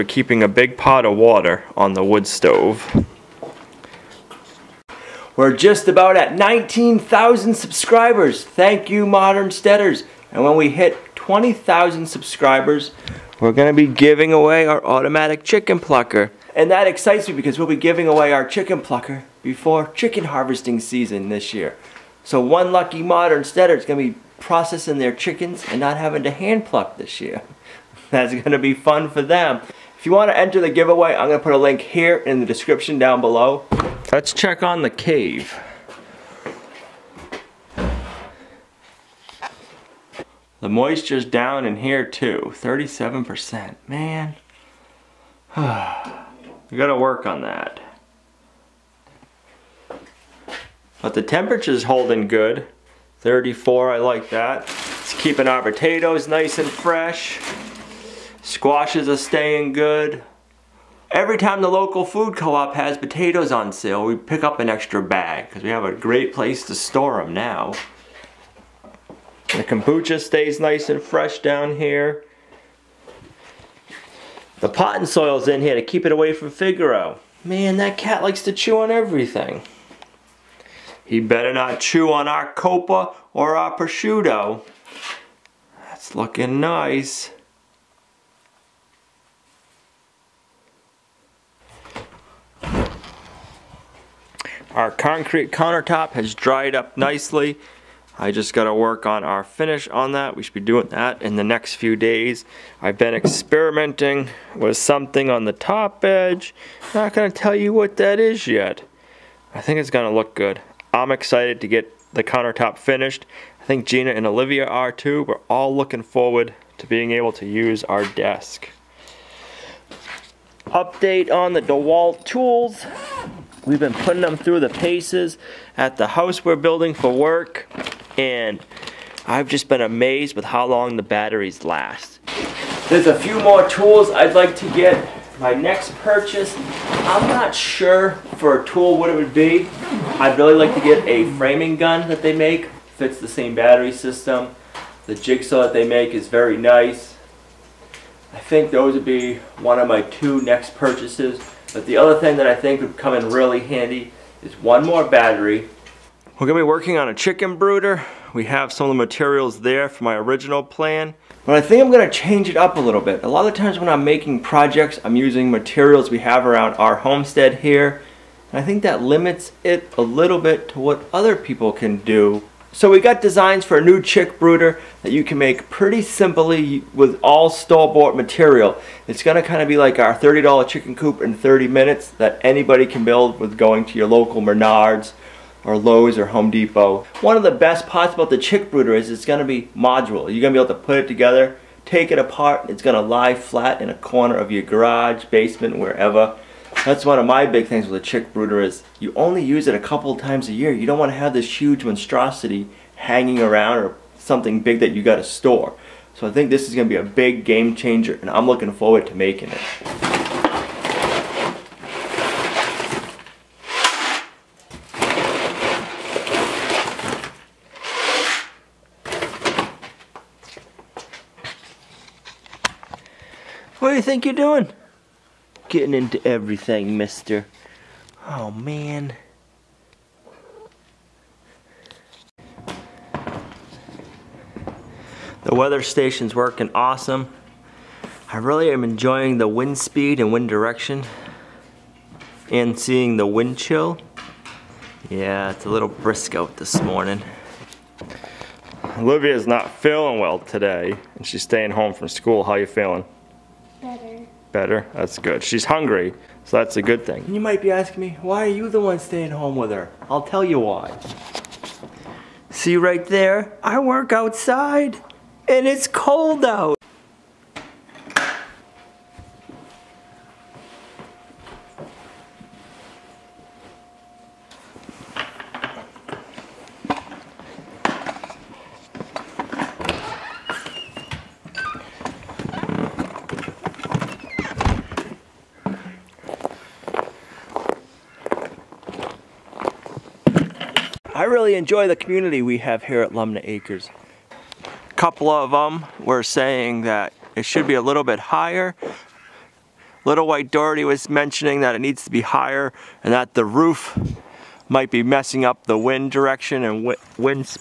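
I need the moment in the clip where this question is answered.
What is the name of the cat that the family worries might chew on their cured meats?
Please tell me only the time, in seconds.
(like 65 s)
76 s.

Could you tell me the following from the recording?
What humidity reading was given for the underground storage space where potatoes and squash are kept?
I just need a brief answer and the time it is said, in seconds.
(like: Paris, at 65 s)
37%, at 42 s.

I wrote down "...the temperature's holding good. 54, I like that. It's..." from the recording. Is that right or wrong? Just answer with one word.
wrong.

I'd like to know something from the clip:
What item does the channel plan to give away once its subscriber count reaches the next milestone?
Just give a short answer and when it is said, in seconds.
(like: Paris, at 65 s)
automatic chicken plucker, at 14 s.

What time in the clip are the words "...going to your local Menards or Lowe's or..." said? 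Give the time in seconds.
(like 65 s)
183 s.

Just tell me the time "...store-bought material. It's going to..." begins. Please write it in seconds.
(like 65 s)
177 s.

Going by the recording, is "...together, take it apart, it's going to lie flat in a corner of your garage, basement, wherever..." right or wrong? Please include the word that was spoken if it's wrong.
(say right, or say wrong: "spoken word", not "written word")
right.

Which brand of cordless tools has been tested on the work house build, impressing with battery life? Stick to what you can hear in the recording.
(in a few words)
DeWalt.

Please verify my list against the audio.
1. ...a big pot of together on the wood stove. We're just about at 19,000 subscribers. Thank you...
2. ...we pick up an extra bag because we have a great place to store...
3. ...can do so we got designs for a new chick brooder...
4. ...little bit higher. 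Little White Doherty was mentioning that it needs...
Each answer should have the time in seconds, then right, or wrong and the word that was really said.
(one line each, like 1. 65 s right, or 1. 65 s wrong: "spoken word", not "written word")
1. 0 s wrong: "water", not "together"
2. 64 s right
3. 171 s right
4. 297 s right.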